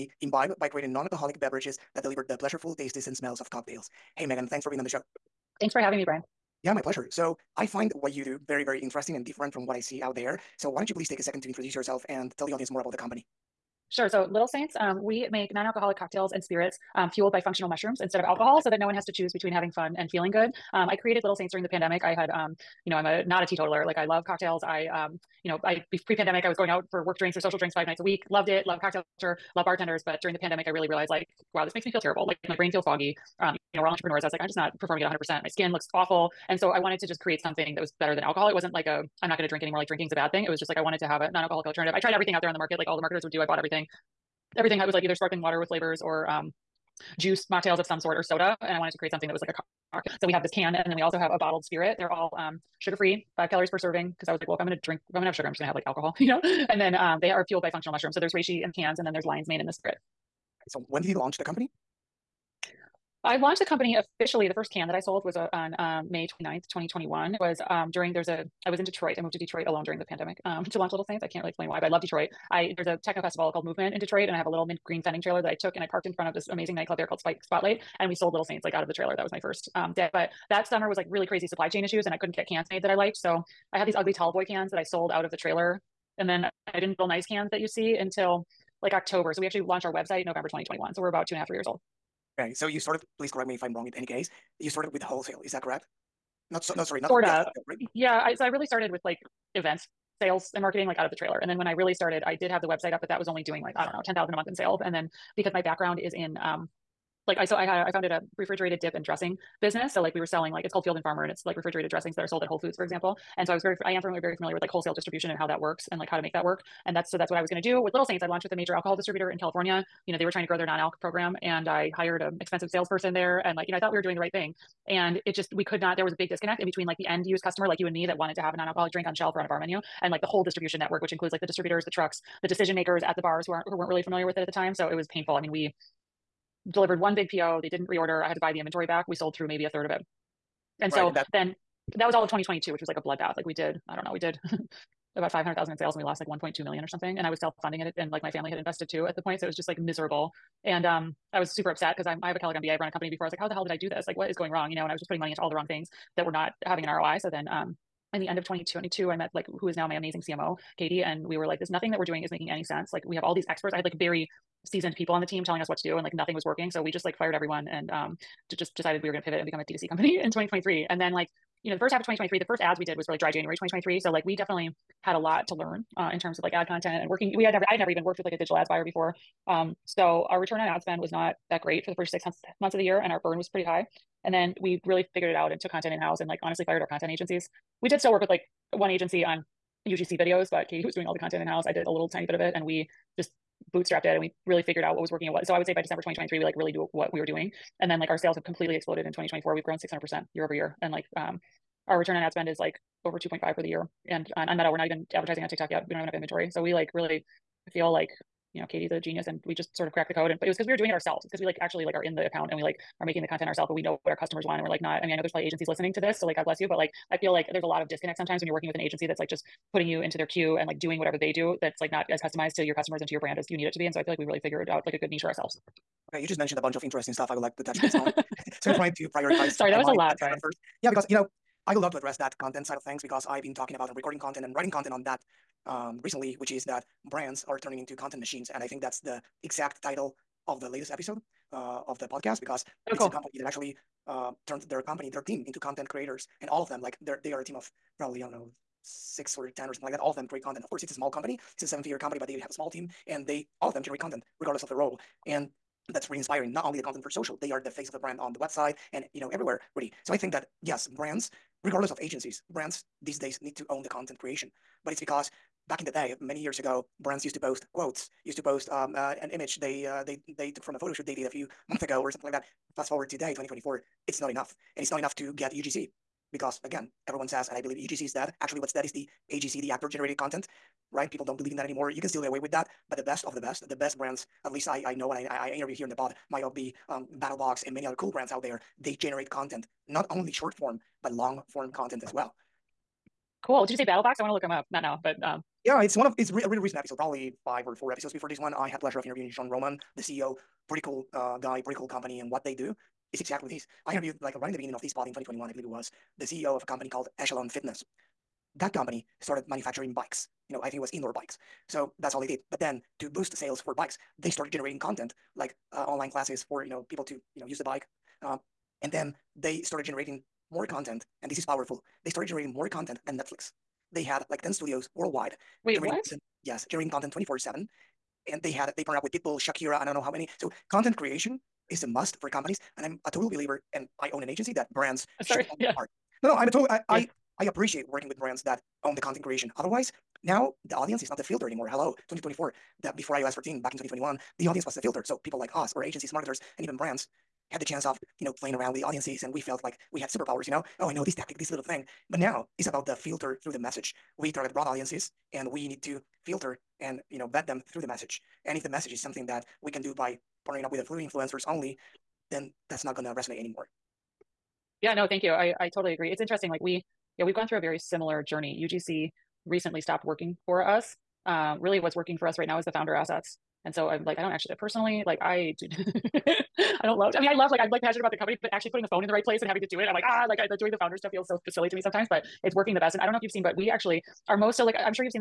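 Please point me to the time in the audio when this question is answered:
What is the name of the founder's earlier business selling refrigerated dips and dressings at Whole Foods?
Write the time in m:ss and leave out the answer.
1:50.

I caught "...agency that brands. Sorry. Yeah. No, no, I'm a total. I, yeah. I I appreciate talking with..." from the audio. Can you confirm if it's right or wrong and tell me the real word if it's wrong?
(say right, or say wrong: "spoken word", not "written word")
wrong: "working", not "talking".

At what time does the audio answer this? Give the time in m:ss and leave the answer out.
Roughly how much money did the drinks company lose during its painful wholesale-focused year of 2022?
2:26.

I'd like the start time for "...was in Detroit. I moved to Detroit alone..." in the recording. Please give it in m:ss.
1:08.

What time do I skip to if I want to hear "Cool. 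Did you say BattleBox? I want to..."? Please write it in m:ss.
4:53.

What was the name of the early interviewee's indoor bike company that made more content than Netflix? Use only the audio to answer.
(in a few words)
Echelon Fitness.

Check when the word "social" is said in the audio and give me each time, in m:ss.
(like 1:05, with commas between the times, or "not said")
0:27, 4:17.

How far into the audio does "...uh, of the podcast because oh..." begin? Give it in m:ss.
4:01.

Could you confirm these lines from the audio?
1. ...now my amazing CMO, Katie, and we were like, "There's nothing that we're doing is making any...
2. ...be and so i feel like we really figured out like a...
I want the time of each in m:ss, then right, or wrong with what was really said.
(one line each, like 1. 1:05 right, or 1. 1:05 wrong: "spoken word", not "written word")
1. 2:39 right
2. 3:43 right.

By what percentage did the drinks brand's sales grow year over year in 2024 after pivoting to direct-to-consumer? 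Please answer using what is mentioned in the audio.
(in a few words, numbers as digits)
600 percent.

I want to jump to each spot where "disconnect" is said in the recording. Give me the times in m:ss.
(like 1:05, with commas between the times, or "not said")
2:06, 3:37.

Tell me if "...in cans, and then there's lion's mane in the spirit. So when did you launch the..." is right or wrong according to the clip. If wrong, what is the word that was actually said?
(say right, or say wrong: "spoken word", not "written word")
right.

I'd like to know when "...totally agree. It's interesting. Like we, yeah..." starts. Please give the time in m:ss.
6:05.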